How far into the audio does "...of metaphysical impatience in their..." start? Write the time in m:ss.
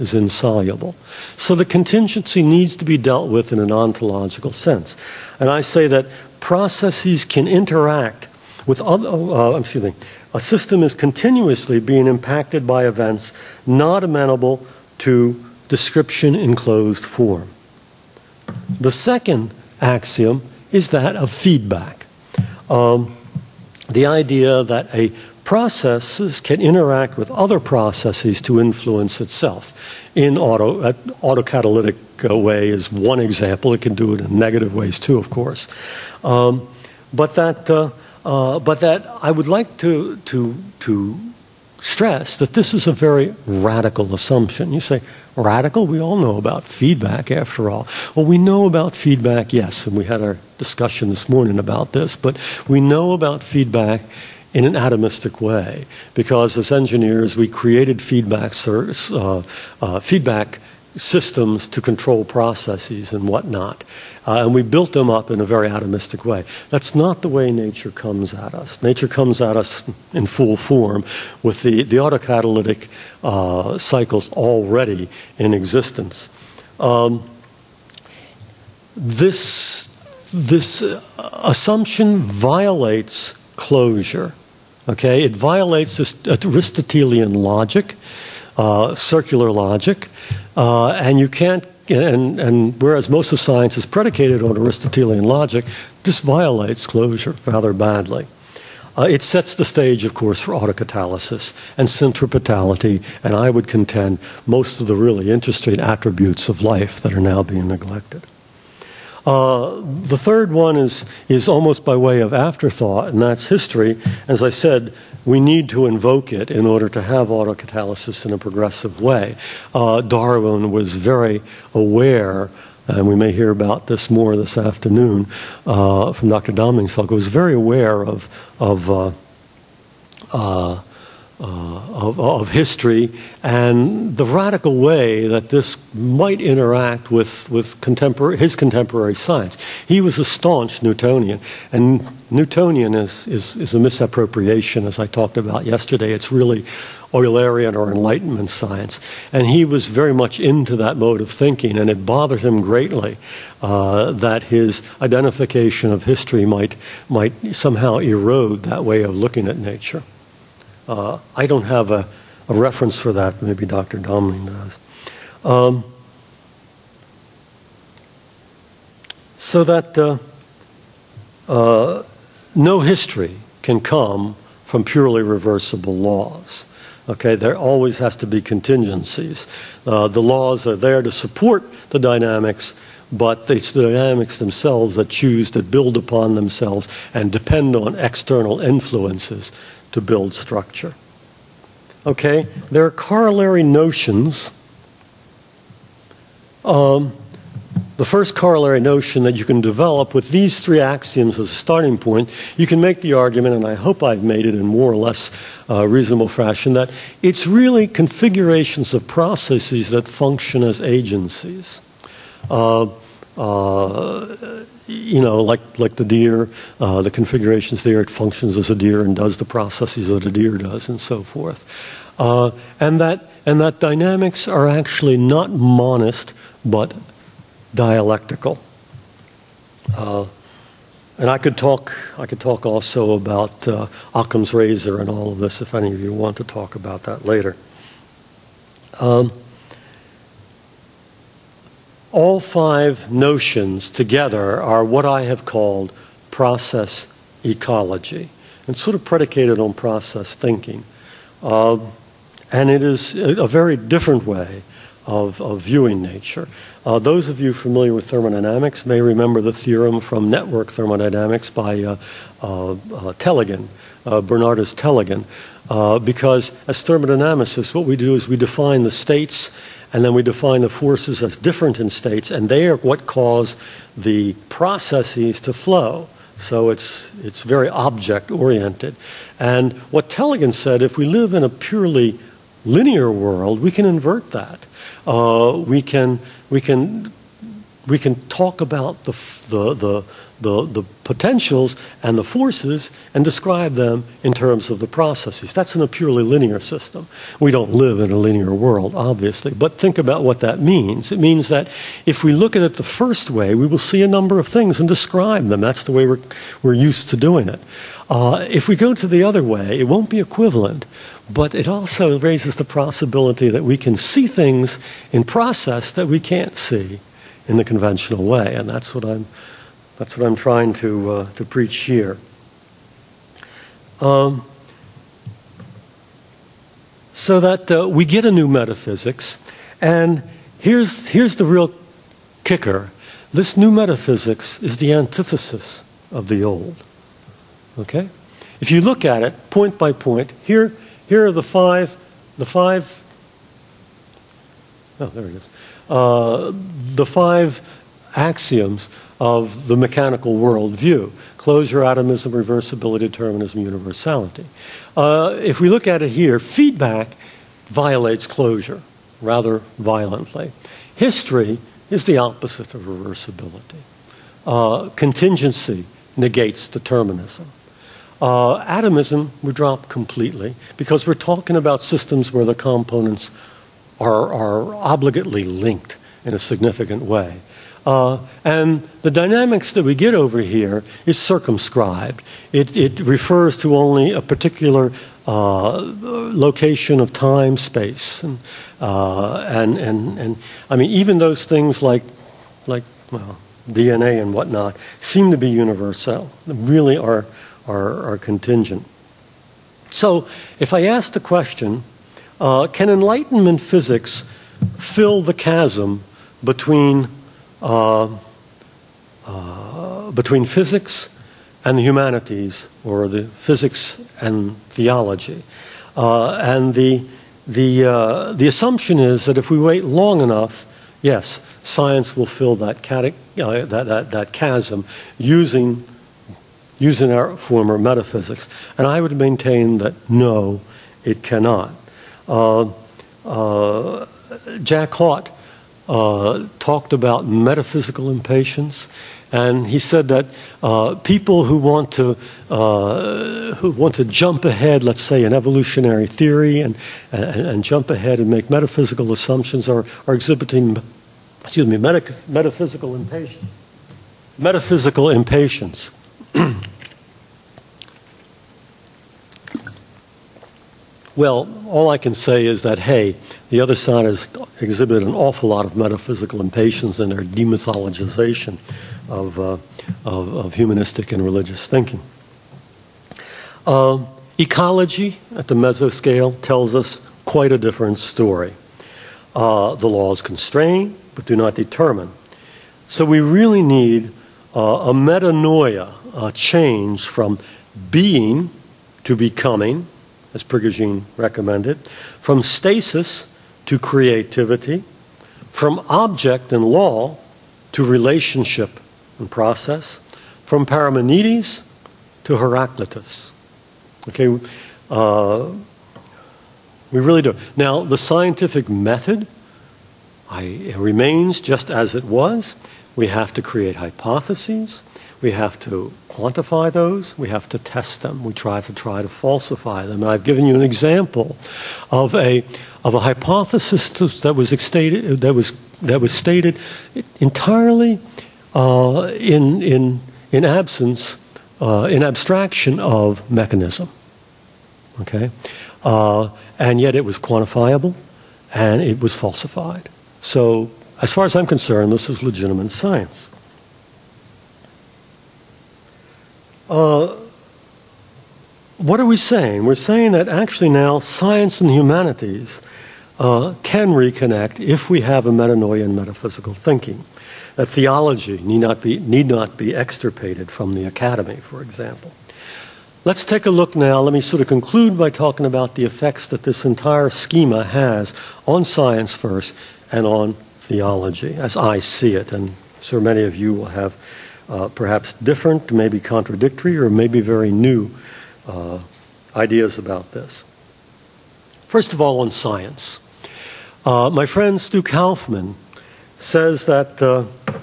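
7:45.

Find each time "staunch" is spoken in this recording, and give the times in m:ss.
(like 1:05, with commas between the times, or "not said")
2:20.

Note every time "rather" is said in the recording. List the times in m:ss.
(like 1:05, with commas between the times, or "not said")
1:37, 5:59.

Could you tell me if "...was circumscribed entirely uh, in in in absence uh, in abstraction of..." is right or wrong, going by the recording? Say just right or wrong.
wrong.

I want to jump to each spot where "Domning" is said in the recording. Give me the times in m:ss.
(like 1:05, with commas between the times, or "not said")
2:06, 2:43.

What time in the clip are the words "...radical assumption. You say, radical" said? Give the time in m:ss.
0:43.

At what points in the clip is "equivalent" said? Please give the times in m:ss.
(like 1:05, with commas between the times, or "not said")
5:10.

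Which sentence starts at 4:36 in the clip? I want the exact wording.
So it's, it's very object oriented.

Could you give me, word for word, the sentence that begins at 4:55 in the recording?
That's in a purely linear system.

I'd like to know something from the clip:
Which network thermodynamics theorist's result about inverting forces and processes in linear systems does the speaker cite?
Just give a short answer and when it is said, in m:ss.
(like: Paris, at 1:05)
Bernardus Tellegen, at 4:24.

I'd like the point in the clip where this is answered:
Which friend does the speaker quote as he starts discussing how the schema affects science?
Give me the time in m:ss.
9:44.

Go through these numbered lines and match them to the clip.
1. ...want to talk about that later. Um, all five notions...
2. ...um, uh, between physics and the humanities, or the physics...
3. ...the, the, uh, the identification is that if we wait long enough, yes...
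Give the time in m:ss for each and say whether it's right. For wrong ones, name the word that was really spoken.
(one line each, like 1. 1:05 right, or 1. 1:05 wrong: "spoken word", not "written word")
1. 3:56 right
2. 6:47 right
3. 6:56 wrong: "assumption", not "identification".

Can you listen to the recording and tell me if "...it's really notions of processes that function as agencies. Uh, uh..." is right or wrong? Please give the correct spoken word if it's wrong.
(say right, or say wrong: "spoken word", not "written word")
wrong: "configurations", not "notions".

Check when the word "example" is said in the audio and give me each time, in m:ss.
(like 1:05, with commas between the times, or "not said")
0:33, 8:40, 9:21.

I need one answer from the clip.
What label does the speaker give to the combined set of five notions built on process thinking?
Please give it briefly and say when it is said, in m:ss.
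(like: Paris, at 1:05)
process ecology, at 4:06.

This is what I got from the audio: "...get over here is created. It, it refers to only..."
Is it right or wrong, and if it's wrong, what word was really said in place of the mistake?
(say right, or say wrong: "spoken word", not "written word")
wrong: "circumscribed", not "created".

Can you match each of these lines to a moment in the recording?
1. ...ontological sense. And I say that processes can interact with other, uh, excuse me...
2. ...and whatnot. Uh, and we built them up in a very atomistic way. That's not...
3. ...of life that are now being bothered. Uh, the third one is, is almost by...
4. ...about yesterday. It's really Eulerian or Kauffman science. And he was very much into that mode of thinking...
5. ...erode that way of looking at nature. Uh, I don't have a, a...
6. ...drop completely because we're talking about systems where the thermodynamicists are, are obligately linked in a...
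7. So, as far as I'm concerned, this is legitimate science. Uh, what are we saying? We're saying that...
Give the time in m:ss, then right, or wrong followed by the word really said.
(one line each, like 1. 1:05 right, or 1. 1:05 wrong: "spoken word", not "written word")
1. 0:03 right
2. 1:03 right
3. 1:46 wrong: "neglected", not "bothered"
4. 2:25 wrong: "Enlightenment", not "Kauffman"
5. 2:37 right
6. 6:09 wrong: "components", not "thermodynamicists"
7. 9:00 right.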